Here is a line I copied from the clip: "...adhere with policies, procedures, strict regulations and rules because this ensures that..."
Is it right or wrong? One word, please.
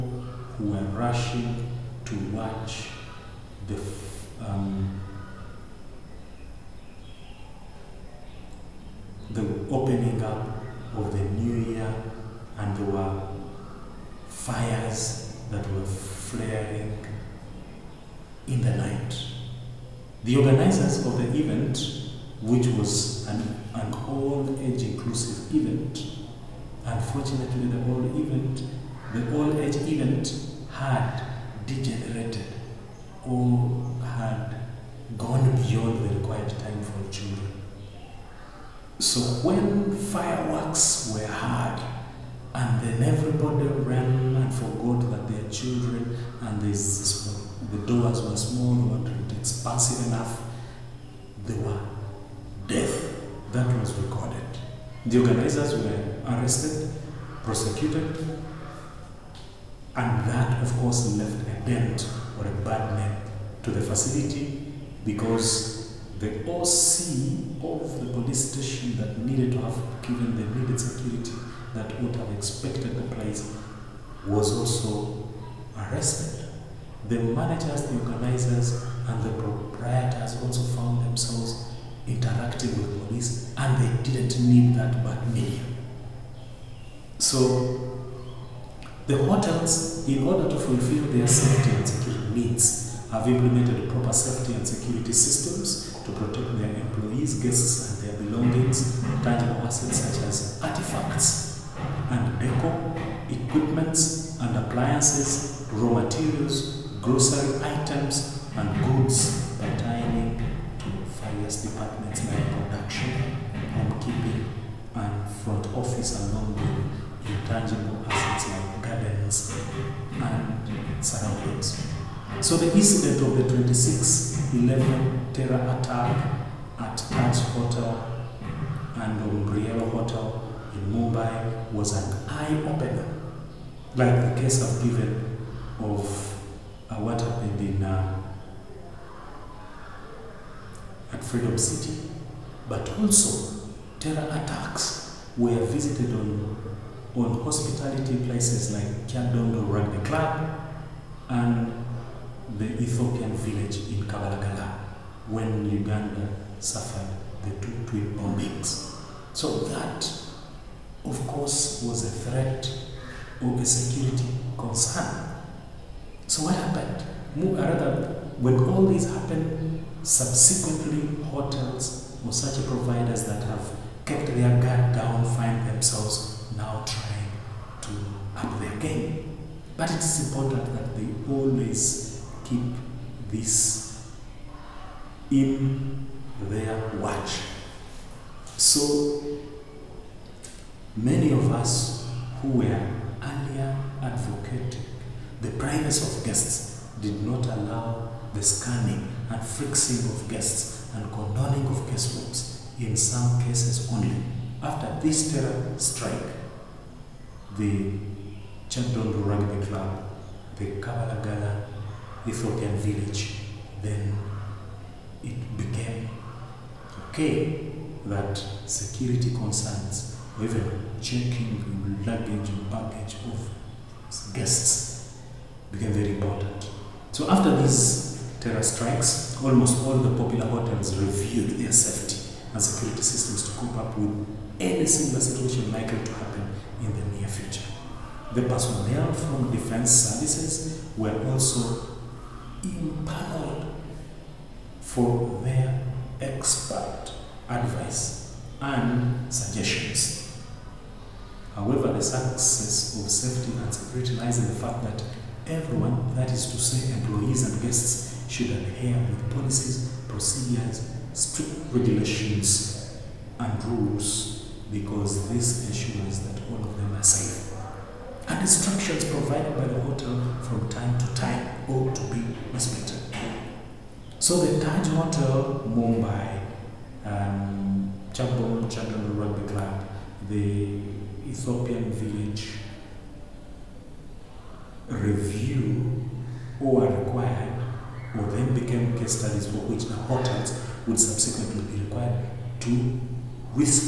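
right.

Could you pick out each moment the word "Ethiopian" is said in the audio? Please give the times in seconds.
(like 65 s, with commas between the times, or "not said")
152 s, 212 s, 281 s.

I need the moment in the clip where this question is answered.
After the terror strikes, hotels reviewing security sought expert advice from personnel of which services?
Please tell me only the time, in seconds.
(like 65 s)
239 s.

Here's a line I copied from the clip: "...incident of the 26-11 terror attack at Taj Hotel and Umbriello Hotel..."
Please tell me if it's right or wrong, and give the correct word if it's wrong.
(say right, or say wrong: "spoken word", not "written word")
right.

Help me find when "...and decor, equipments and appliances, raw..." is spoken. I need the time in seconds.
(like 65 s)
102 s.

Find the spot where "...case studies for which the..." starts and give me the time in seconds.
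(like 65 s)
288 s.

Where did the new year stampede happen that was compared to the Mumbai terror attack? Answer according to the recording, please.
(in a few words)
Freedom City.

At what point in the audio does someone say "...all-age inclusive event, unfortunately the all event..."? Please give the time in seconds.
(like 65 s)
23 s.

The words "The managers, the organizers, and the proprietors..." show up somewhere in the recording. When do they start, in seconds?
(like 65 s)
77 s.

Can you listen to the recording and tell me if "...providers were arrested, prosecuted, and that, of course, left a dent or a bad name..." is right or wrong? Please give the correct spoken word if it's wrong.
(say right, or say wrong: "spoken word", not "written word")
wrong: "organizers", not "providers".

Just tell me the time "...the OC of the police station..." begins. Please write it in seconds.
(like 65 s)
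66 s.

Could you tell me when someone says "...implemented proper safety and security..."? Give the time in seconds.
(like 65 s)
93 s.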